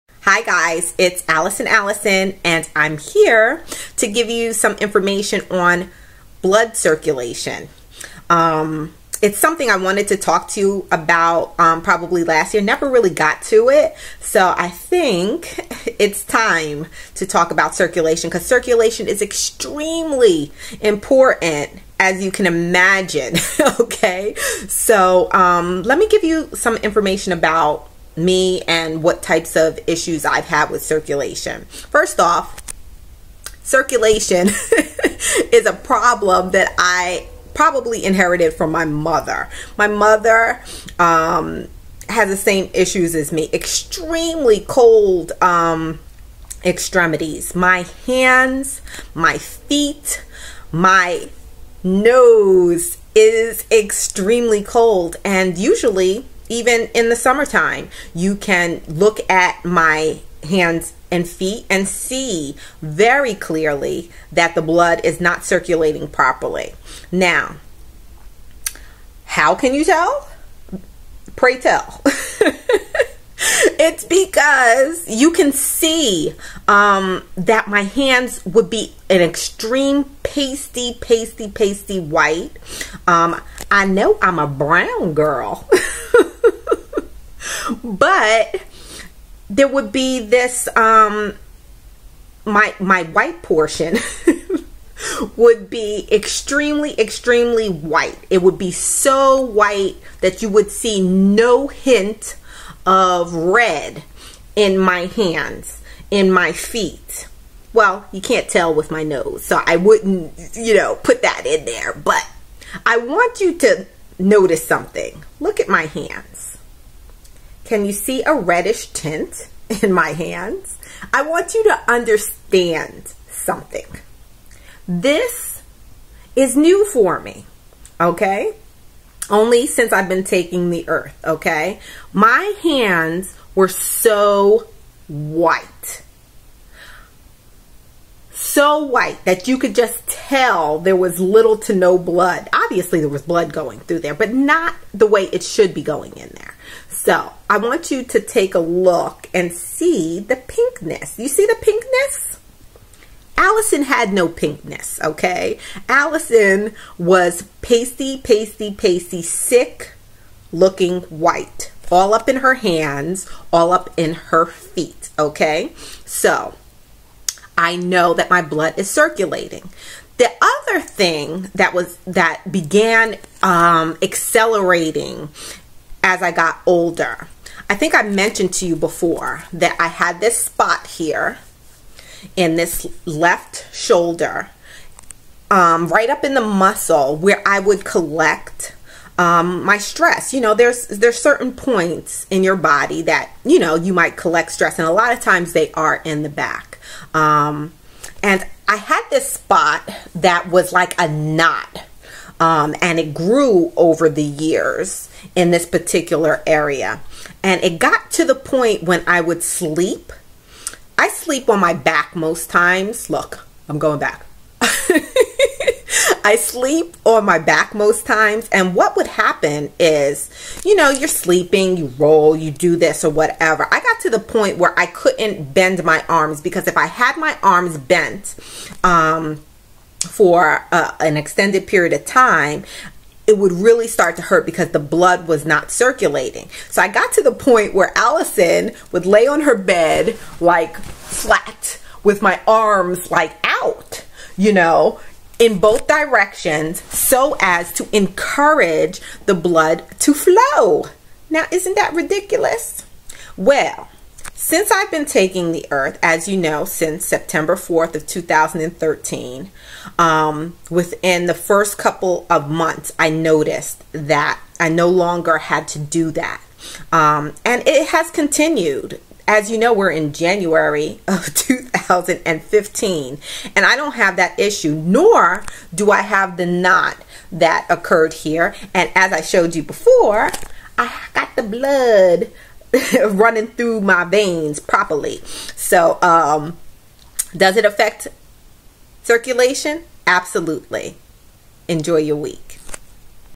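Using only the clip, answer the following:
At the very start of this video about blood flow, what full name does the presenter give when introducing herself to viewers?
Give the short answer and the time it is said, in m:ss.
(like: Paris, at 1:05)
Alison Allison, at 0:01.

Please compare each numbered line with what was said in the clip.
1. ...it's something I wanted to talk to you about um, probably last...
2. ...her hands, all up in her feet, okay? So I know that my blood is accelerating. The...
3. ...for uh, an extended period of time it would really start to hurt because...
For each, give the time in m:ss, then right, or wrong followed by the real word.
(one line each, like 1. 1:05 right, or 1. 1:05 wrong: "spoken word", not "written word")
1. 0:09 right
2. 2:42 wrong: "circulating", not "accelerating"
3. 3:50 right.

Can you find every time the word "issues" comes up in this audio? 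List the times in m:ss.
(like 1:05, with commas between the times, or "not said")
0:29, 0:42, 4:34.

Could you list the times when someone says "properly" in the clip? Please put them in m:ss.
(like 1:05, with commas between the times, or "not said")
1:06, 4:44.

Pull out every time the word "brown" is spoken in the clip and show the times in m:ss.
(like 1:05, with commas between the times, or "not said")
1:24.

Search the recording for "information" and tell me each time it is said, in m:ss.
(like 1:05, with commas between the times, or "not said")
0:04, 0:26.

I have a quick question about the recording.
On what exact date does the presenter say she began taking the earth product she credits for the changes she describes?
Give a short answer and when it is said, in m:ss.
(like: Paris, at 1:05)
September 4, 2013, at 4:17.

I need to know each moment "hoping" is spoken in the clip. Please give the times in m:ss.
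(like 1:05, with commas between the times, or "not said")
not said.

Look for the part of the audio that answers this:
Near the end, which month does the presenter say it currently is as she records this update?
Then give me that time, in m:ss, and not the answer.
4:30.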